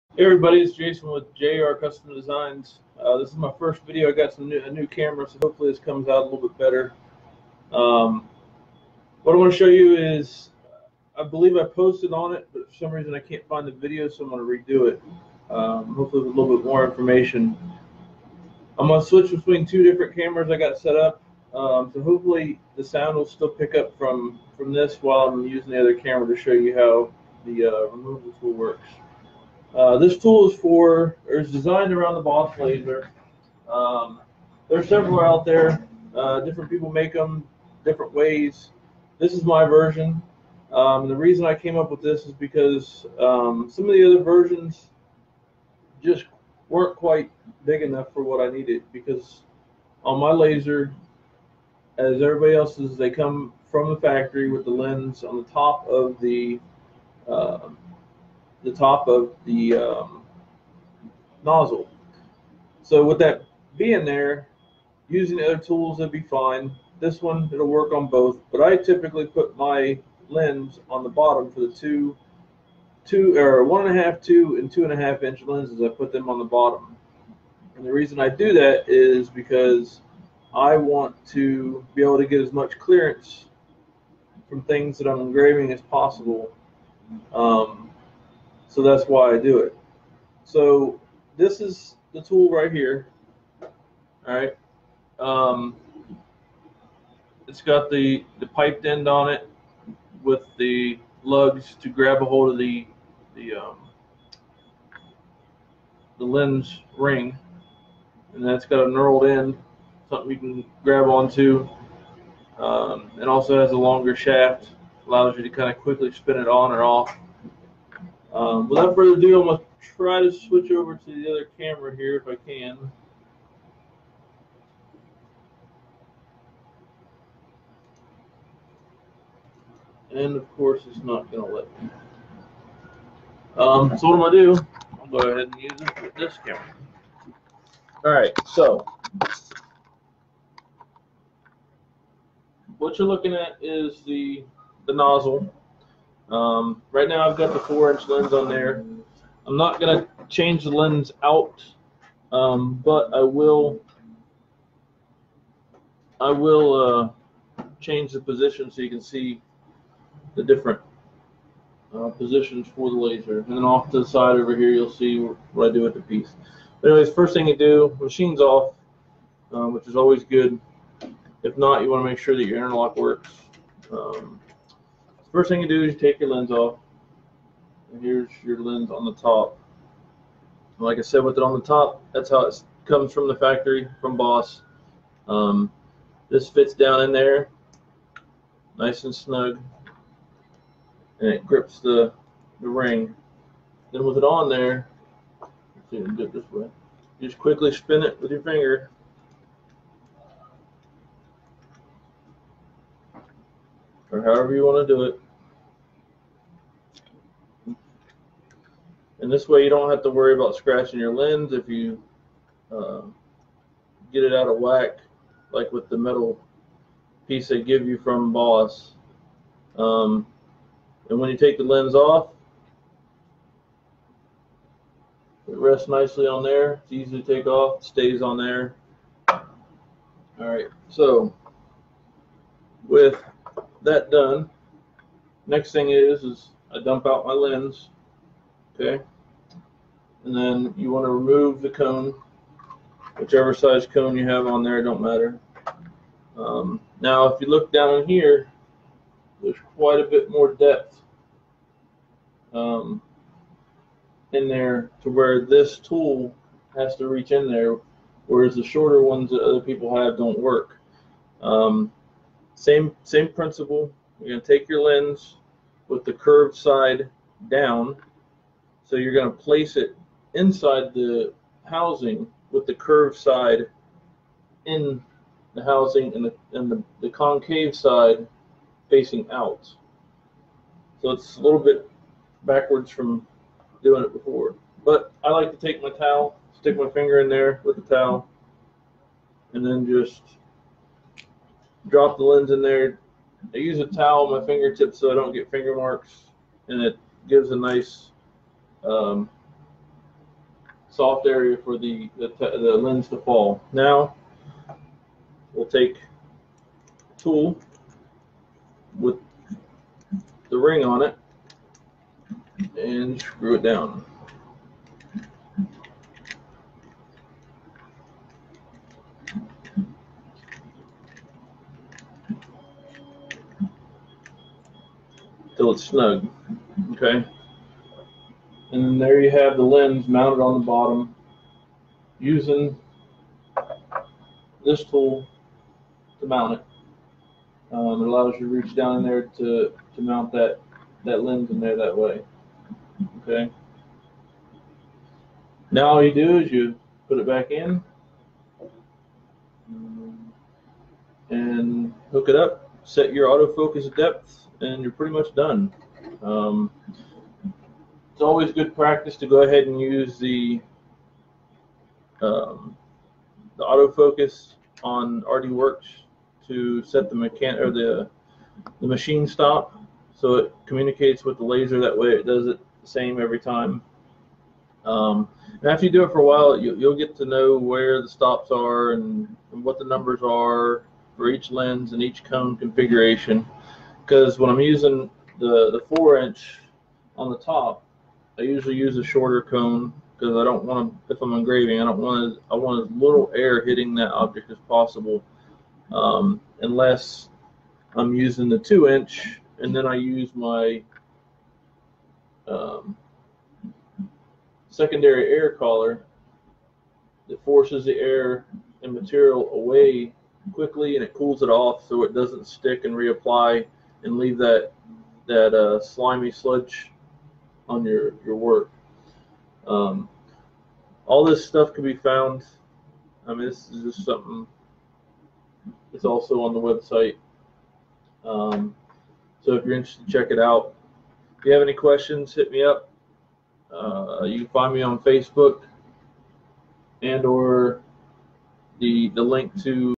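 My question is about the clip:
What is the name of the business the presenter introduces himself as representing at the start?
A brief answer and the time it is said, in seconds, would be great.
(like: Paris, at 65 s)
JR Custom Designs, at 1 s.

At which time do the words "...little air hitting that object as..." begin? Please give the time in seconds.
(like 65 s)
393 s.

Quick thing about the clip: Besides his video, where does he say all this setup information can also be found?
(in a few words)
The website.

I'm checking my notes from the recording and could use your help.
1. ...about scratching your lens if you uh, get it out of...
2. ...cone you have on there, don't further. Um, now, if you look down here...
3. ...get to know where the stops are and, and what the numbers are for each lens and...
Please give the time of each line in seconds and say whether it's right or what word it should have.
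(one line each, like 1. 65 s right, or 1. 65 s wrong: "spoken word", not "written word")
1. 210 s right
2. 243 s wrong: "matter", not "further"
3. 376 s right.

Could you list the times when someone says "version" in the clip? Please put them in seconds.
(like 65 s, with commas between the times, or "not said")
39 s, 44 s.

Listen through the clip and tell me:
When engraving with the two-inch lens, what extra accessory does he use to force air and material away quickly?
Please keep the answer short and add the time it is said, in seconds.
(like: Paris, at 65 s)
Secondary air collar, at 404 s.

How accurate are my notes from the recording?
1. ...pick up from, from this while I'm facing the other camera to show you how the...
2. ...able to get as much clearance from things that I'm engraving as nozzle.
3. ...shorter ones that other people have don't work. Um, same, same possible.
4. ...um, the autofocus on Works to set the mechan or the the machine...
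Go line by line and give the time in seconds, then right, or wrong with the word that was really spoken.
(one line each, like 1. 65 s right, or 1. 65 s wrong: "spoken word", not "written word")
1. 23 s wrong: "using", not "facing"
2. 82 s wrong: "possible", not "nozzle"
3. 258 s wrong: "principle", not "possible"
4. 362 s right.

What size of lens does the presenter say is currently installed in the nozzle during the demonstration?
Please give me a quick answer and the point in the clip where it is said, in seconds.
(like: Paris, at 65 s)
4 inch, at 147 s.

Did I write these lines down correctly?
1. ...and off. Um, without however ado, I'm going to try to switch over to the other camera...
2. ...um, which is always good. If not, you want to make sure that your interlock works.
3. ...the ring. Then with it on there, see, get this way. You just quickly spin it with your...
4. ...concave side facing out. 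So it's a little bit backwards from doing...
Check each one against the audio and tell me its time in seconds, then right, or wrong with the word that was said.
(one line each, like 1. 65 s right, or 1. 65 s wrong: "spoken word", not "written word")
1. 116 s wrong: "further", not "however"
2. 169 s right
3. 192 s right
4. 277 s right.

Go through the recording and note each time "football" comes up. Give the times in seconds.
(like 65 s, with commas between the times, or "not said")
not said.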